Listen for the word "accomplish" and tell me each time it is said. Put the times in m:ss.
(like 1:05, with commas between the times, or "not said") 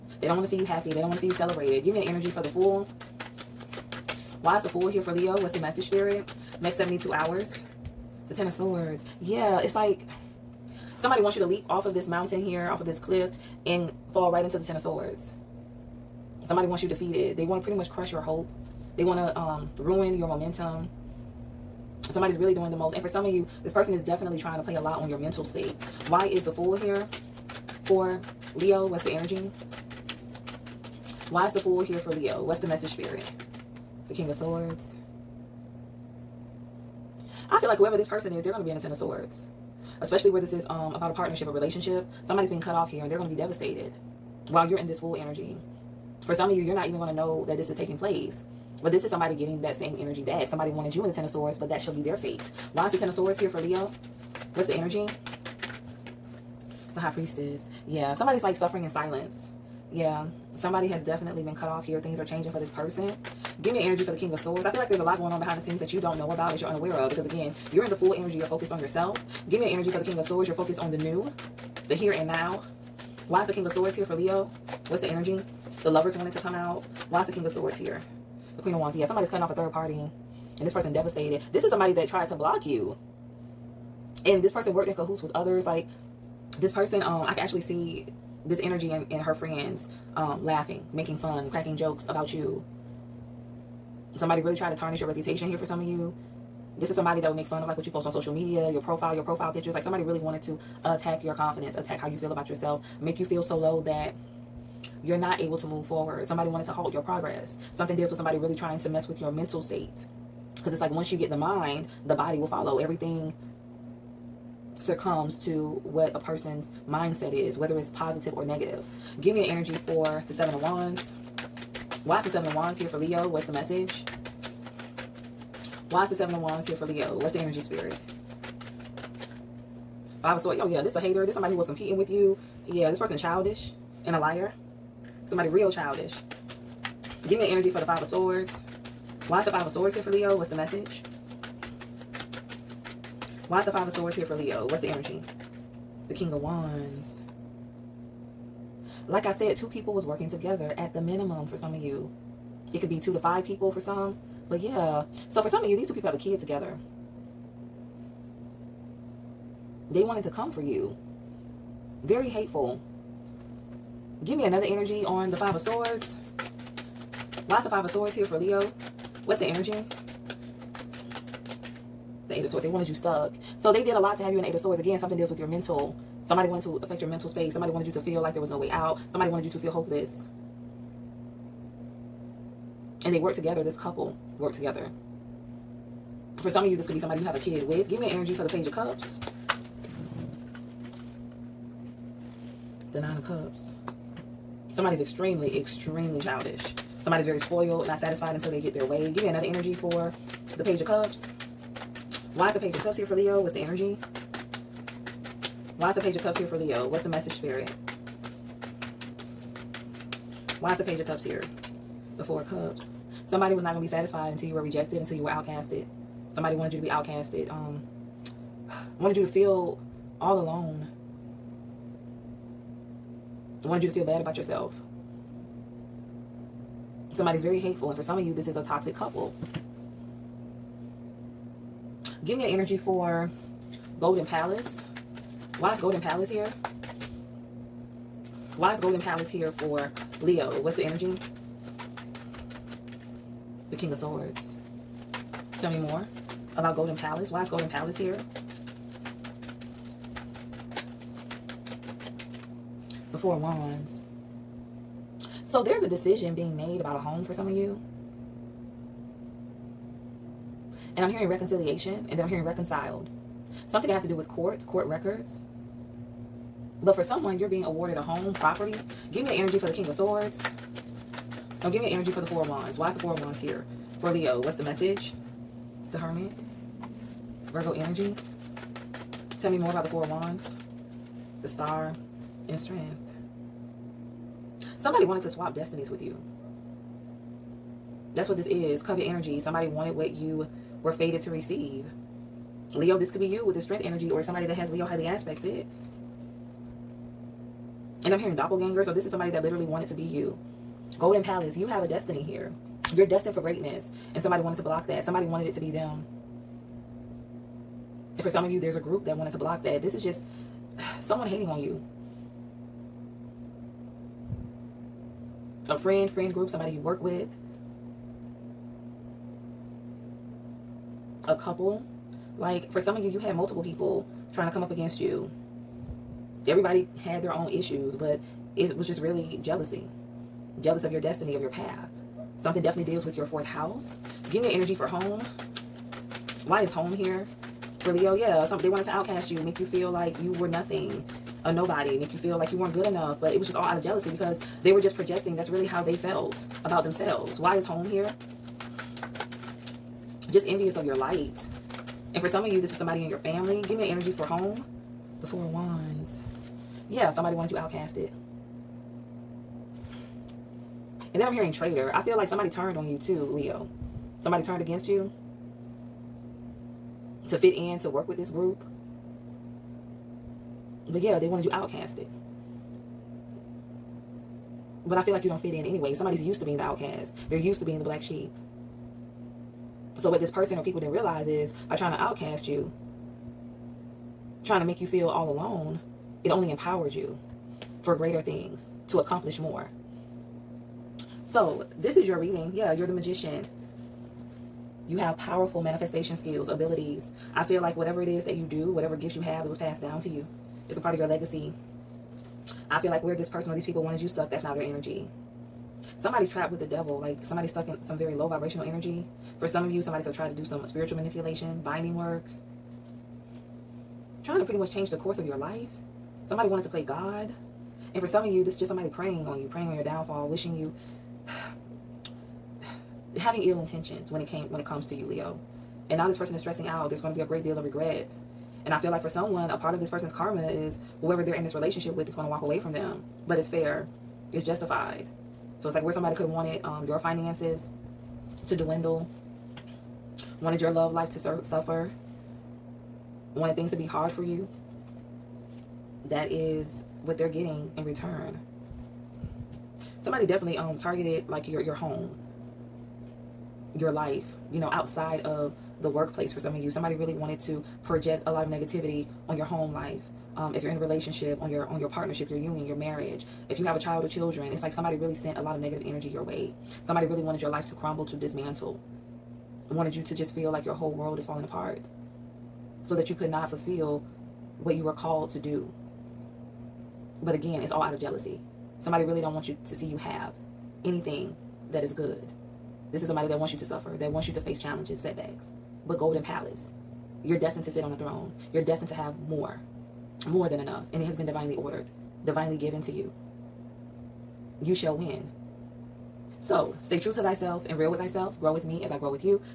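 6:28.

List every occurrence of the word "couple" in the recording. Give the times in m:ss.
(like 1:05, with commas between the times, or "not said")
3:03, 3:48, 5:21.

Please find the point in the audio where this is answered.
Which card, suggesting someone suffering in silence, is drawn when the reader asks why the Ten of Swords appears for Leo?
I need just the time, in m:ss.
0:56.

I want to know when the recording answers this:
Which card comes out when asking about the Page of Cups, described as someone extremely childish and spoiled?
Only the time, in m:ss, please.
3:12.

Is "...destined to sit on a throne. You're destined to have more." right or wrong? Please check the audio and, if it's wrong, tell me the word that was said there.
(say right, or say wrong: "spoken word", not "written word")
right.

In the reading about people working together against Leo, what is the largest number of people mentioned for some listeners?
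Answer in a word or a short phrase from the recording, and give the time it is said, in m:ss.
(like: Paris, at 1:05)
5, at 2:32.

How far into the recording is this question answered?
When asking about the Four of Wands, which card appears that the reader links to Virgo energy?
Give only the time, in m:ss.
4:35.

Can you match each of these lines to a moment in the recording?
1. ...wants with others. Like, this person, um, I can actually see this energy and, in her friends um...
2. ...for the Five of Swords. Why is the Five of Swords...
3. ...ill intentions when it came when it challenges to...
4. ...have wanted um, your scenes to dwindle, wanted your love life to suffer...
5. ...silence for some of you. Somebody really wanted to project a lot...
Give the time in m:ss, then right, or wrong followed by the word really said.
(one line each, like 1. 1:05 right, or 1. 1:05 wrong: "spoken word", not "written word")
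1. 1:24 wrong: "cahoots", not "wants"
2. 2:17 right
3. 7:03 wrong: "comes", not "challenges"
4. 7:16 wrong: "finances", not "scenes"
5. 7:35 wrong: "workplace", not "silence".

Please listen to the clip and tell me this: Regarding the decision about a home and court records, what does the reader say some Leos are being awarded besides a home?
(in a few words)
Property.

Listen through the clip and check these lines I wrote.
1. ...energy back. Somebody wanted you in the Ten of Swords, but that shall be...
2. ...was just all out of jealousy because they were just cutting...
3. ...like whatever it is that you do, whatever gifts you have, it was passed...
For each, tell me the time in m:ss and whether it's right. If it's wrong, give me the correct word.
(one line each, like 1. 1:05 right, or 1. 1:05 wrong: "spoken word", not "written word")
1. 0:49 right
2. 5:43 wrong: "projecting", not "cutting"
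3. 6:37 right.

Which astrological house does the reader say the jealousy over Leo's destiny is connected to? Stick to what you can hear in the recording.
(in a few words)
Fourth house.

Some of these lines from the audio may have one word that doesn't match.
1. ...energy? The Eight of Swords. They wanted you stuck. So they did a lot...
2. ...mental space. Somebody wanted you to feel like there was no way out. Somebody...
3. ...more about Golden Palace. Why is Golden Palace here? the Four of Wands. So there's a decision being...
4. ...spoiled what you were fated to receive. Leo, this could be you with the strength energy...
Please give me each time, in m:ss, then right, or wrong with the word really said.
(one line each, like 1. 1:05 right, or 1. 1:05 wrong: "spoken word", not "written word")
1. 2:49 right
2. 2:57 right
3. 4:05 right
4. 4:49 wrong: "wanted", not "spoiled".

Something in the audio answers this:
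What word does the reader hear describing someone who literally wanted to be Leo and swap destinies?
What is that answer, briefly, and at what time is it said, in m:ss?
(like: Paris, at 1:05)
Doppelganger, at 4:58.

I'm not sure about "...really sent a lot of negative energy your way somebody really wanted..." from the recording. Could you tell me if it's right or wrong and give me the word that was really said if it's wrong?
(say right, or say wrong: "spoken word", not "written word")
right.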